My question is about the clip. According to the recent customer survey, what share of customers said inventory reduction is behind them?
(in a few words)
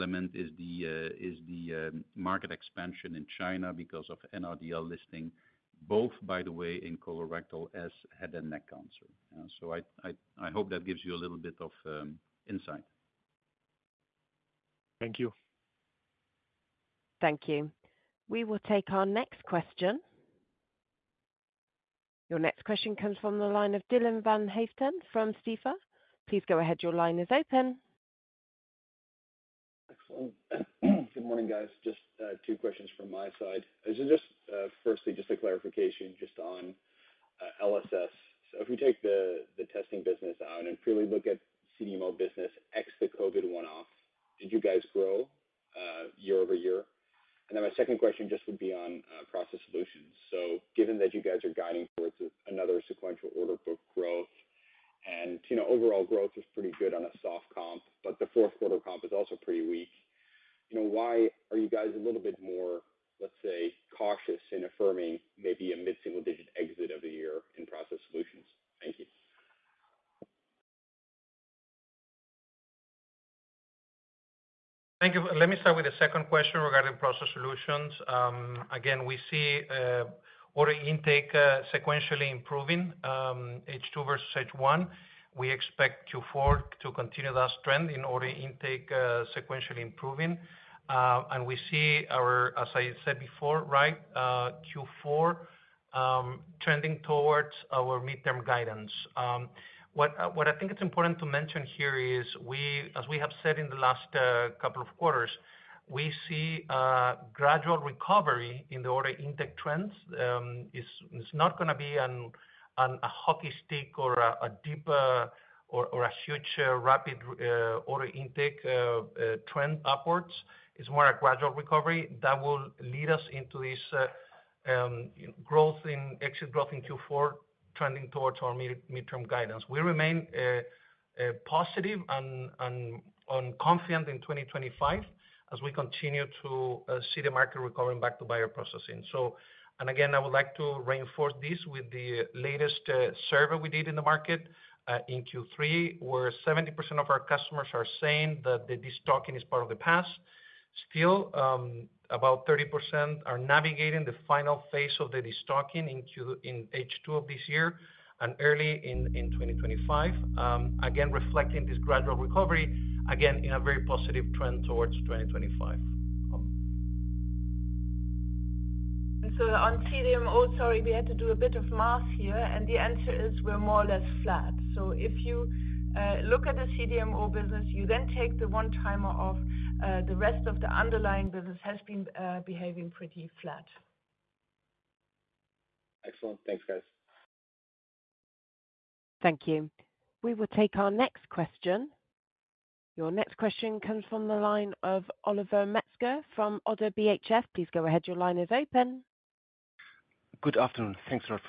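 70%.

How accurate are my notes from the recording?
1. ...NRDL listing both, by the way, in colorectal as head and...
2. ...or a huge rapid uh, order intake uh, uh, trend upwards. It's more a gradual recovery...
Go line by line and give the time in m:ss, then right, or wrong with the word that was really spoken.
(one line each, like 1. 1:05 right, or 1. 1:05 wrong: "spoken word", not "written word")
1. 0:04 right
2. 1:55 right.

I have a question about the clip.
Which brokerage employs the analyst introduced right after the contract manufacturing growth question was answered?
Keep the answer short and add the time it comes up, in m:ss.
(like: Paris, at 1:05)
ODDO BHF, at 3:16.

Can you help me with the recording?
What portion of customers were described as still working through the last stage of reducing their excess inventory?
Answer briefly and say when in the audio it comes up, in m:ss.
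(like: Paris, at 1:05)
30%, at 2:32.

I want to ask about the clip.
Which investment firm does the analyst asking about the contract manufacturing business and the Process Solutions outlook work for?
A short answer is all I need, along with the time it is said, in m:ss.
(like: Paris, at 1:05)
Stifel, at 0:25.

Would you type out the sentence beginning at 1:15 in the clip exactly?
Let me start with the second question regarding Process Solutions.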